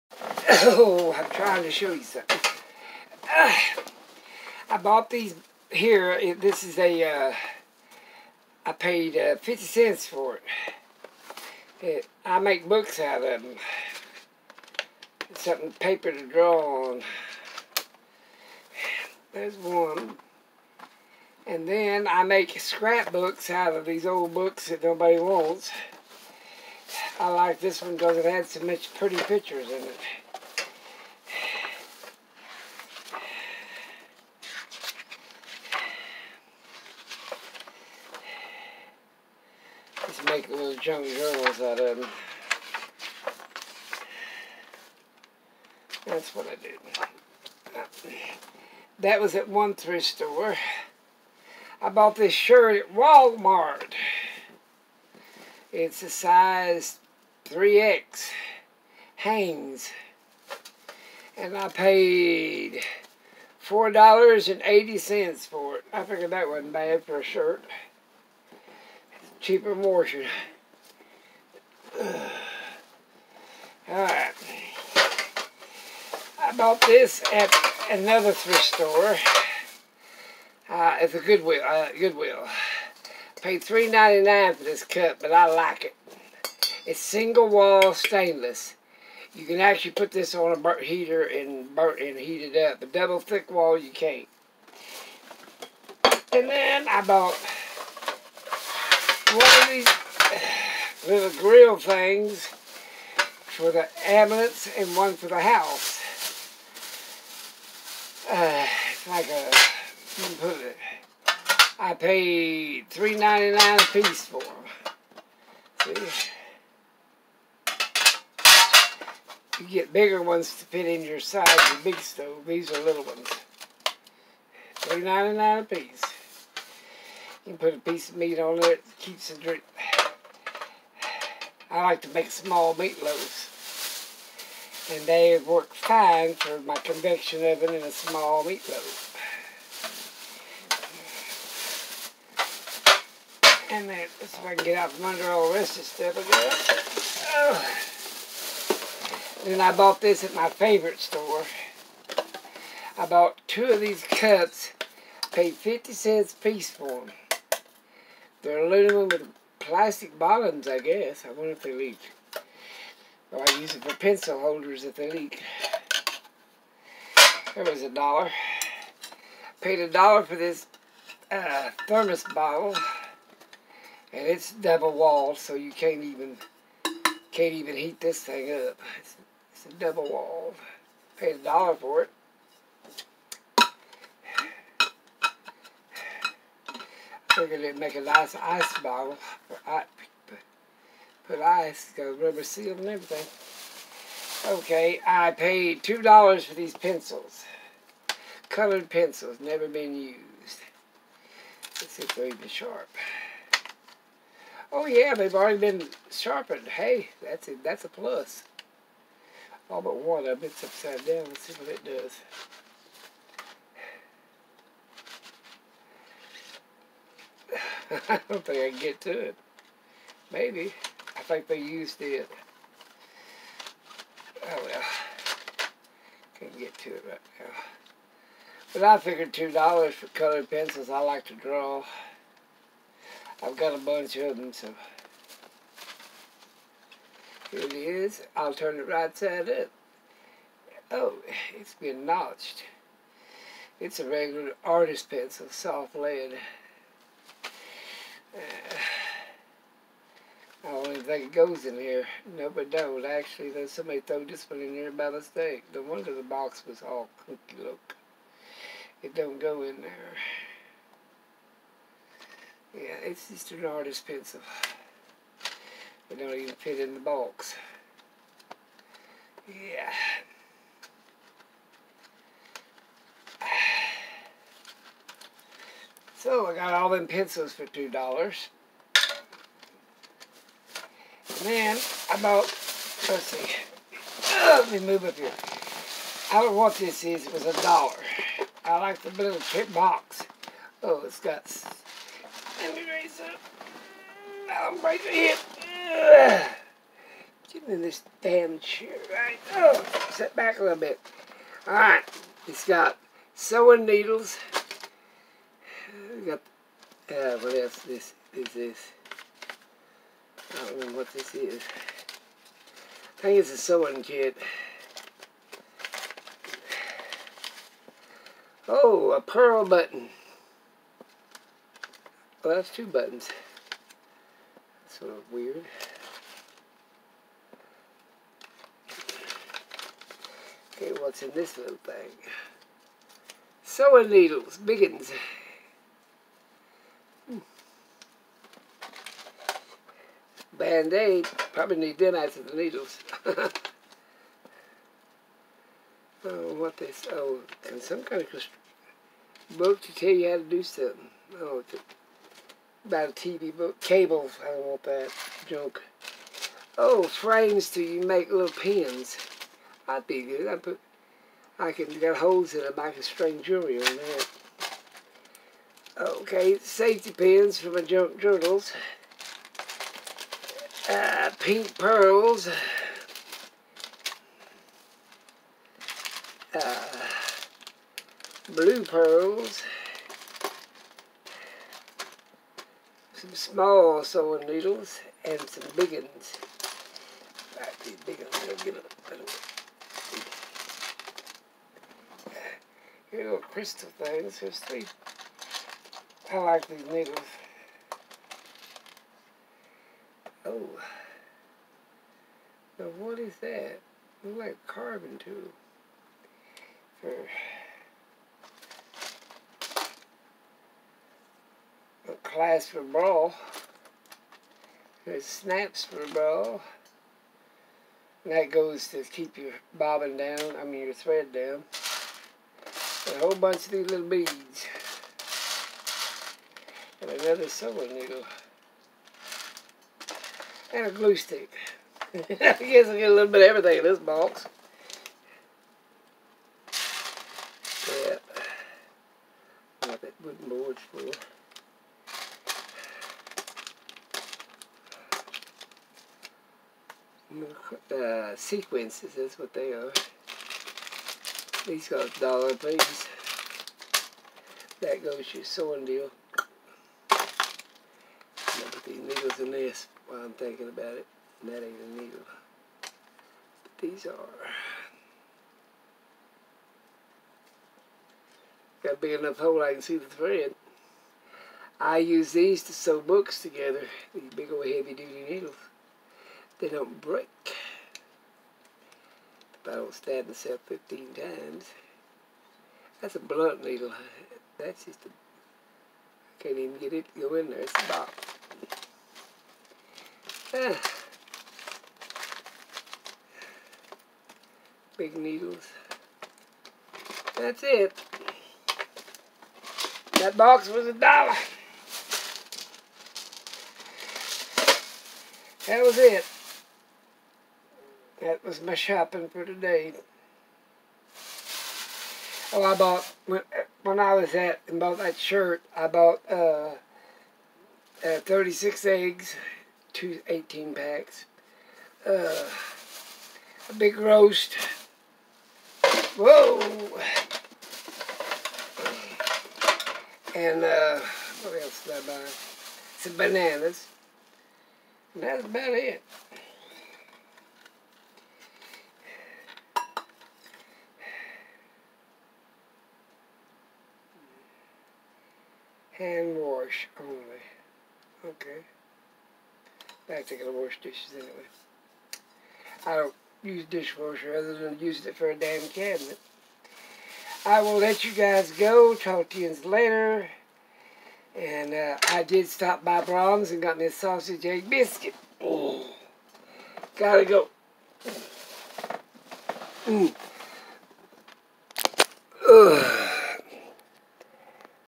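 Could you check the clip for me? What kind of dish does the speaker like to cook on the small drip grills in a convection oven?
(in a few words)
Small meatloaves.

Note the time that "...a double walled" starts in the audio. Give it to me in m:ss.
2:59.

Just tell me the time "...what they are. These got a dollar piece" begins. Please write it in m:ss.
7:29.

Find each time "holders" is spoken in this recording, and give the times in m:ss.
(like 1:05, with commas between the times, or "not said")
2:44.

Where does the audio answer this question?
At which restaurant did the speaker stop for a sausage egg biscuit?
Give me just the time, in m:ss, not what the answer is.
9:23.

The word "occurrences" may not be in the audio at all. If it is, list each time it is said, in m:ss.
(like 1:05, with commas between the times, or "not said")
not said.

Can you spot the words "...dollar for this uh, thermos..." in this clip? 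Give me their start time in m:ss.
2:49.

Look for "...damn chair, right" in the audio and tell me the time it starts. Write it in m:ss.
4:58.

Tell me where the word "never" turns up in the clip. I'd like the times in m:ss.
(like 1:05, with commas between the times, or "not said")
3:19.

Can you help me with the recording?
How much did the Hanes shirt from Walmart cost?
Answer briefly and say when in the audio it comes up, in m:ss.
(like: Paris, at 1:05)
$4.80, at 1:03.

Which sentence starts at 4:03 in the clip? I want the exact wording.
It's a regular artist pencil, soft lead.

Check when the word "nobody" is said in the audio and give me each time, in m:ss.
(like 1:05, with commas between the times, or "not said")
0:24.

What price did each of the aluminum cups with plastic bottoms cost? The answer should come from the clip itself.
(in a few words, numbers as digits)
50 cents.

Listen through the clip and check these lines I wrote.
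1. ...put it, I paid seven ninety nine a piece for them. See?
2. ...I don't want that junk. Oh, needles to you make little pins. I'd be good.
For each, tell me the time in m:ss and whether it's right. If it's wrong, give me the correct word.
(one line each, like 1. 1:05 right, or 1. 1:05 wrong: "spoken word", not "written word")
1. 1:50 wrong: "three", not "seven"
2. 5:54 wrong: "frames", not "needles".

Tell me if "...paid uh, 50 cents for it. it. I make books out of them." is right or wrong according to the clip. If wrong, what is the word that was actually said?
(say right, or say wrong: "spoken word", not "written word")
right.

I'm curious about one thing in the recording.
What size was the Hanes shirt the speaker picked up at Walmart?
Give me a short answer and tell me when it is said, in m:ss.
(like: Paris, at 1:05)
3X, at 0:56.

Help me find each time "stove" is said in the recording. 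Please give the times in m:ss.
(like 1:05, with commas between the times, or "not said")
2:01.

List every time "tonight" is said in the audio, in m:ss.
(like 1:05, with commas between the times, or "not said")
not said.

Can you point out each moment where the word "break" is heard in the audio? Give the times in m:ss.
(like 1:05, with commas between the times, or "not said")
4:54, 7:57.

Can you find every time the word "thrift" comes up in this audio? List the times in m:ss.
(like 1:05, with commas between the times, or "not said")
0:49, 1:18.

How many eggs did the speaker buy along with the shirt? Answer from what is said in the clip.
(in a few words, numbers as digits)
36.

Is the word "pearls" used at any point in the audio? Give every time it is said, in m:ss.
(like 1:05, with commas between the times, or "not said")
5:19, 6:11, 6:18.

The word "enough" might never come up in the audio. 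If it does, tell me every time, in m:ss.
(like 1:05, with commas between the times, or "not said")
7:49.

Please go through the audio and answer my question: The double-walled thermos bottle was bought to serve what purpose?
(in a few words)
Ice bottle.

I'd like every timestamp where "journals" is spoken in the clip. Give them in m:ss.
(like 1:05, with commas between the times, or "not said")
0:41, 6:08.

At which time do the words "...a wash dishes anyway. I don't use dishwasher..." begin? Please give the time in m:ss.
9:10.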